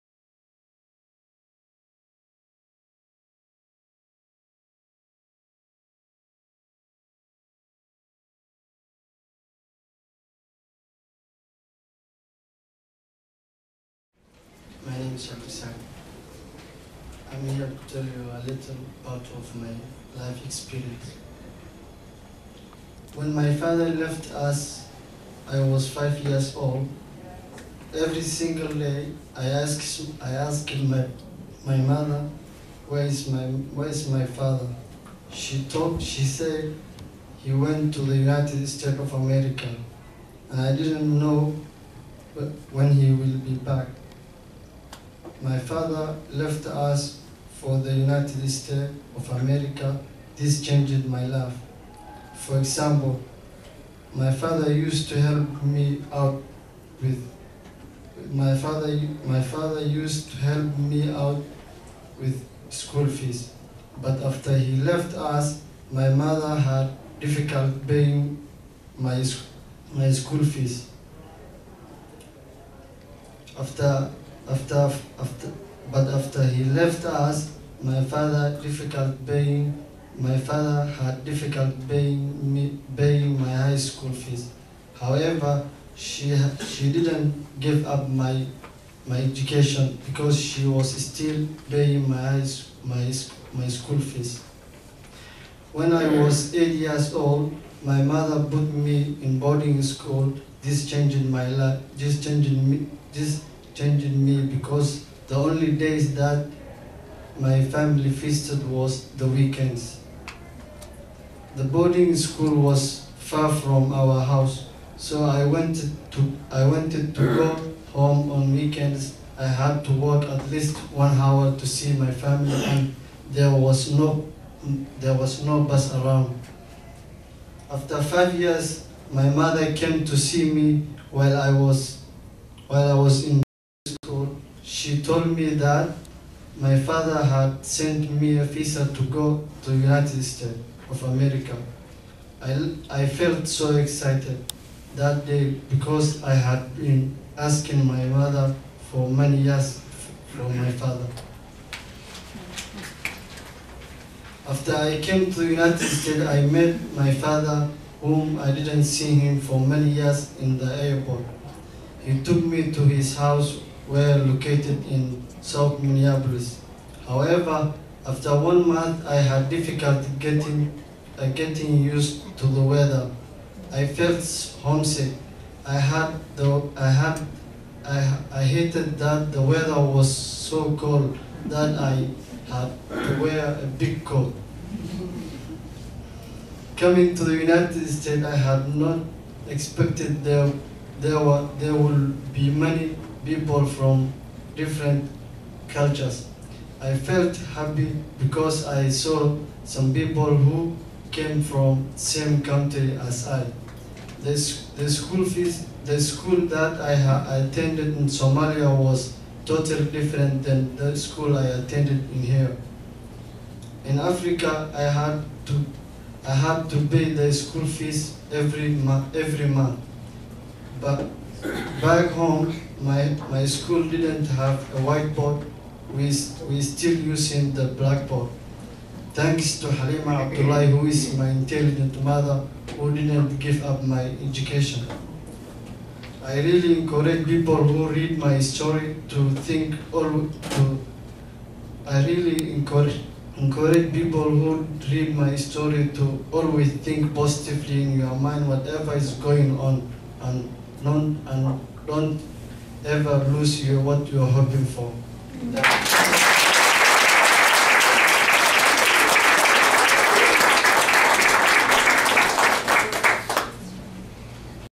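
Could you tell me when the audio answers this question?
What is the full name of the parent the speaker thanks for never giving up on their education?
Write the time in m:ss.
3:49.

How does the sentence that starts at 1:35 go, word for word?
When I was eight years old, my mother put me in boarding school.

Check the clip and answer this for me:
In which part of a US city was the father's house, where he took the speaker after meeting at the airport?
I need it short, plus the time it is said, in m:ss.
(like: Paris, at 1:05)
South Minneapolis, at 2:45.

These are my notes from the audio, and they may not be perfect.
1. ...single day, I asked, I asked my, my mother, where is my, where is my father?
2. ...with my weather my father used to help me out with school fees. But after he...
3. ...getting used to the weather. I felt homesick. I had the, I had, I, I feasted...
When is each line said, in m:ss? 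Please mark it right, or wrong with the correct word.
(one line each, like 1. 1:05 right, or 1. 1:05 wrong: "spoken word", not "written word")
1. 0:28 right
2. 0:57 wrong: "father", not "weather"
3. 2:51 wrong: "hated", not "feasted".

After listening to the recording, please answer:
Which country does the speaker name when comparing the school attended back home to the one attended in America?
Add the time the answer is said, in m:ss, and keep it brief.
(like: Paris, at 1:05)
Somalia, at 3:28.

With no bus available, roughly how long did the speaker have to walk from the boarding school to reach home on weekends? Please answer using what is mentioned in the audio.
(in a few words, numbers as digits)
1 hour.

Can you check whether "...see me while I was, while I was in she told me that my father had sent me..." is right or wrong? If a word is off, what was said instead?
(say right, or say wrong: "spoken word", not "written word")
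right.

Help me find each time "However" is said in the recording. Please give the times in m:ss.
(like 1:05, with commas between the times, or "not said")
1:24, 2:47.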